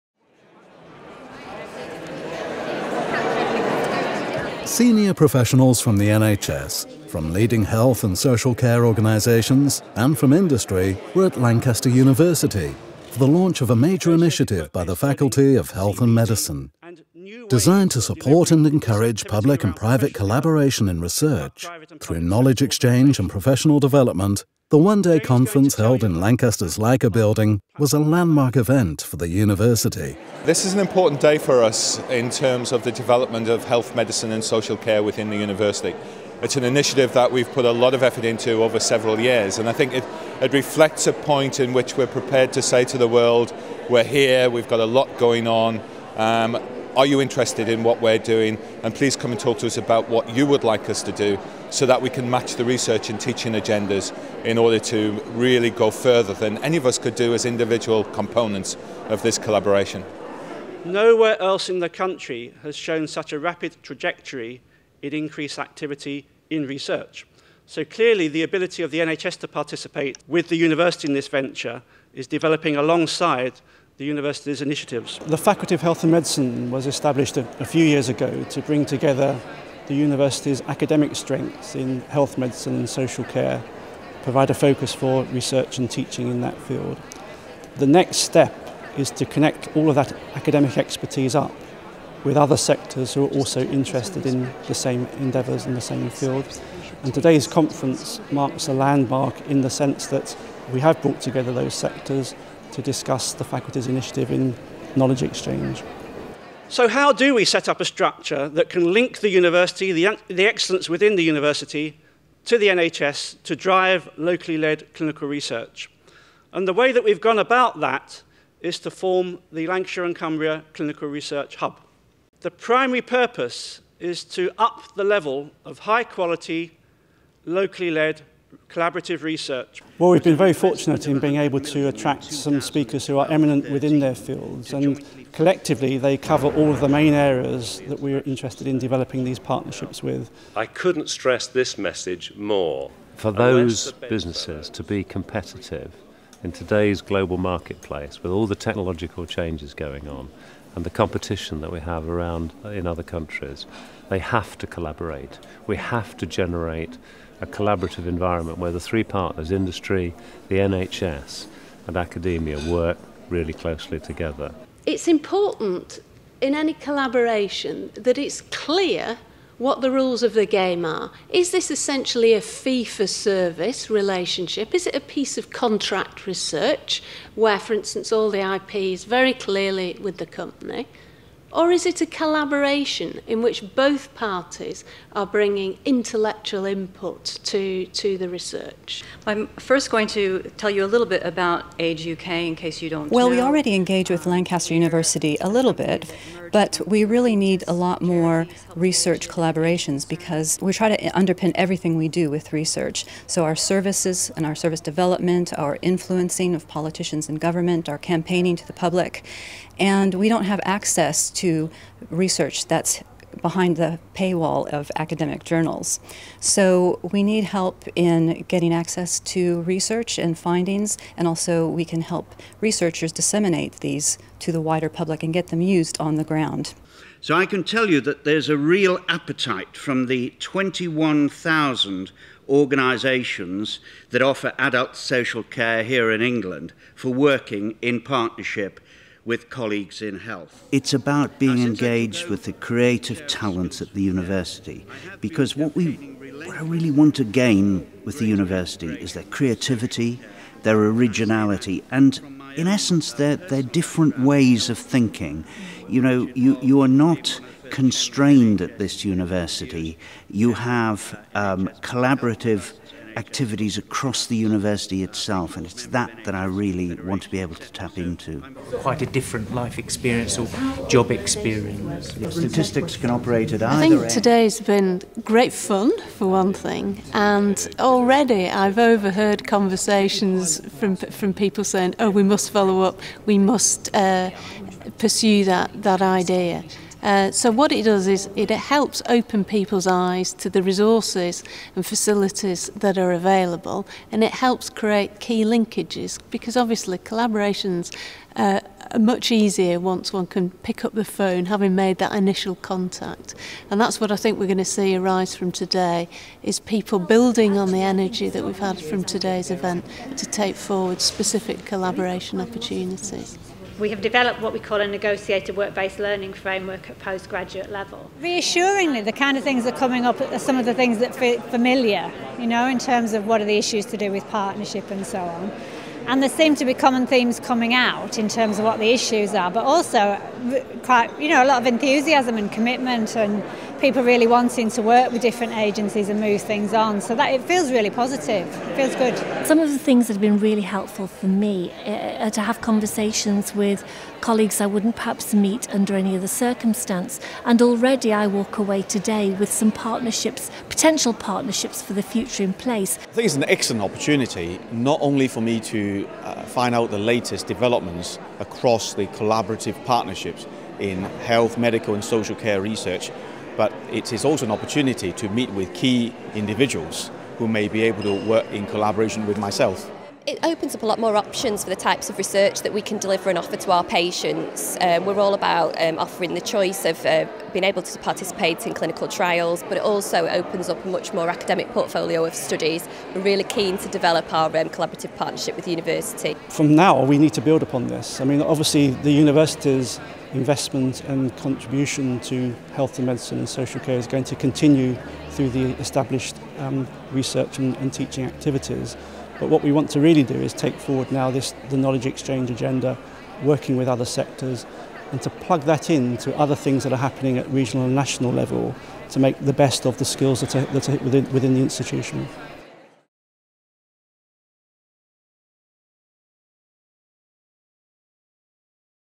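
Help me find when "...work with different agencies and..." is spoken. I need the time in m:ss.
5:34.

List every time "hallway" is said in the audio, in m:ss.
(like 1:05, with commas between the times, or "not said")
not said.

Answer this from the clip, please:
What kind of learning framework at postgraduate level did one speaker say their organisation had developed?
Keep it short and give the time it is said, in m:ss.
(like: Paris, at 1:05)
negotiated work-based learning framework, at 5:14.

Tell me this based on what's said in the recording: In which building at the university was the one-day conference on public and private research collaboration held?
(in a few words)
LICA building.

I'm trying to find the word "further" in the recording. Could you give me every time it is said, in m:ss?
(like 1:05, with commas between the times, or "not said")
0:55.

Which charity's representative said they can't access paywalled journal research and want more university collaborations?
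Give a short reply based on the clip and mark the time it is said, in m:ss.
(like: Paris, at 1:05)
Age UK, at 3:11.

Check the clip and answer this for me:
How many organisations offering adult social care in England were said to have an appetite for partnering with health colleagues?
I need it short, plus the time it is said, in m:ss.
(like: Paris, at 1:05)
21,000, at 3:50.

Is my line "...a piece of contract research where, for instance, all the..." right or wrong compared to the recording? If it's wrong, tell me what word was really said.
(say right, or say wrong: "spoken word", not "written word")
right.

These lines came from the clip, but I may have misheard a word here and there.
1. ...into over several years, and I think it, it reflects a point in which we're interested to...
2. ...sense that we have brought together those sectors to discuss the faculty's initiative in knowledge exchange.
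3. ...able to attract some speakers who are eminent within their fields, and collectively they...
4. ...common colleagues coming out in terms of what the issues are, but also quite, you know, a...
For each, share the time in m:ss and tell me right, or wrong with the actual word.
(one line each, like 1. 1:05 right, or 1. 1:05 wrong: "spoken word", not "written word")
1. 0:38 wrong: "prepared", not "interested"
2. 1:39 right
3. 2:11 right
4. 5:26 wrong: "themes", not "colleagues".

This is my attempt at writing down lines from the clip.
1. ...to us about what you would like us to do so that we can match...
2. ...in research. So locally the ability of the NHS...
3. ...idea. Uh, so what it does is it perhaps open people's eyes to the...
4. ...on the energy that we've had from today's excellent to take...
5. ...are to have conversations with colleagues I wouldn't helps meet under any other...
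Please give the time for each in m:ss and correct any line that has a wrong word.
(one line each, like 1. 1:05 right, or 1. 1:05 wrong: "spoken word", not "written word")
1. 0:49 right
2. 1:06 wrong: "clearly", not "locally"
3. 4:46 wrong: "helps", not "perhaps"
4. 5:07 wrong: "event", not "excellent"
5. 5:42 wrong: "perhaps", not "helps".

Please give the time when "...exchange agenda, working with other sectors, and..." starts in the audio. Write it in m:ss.
6:42.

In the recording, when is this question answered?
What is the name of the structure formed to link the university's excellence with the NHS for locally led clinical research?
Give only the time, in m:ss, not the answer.
1:59.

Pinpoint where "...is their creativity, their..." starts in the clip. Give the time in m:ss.
4:08.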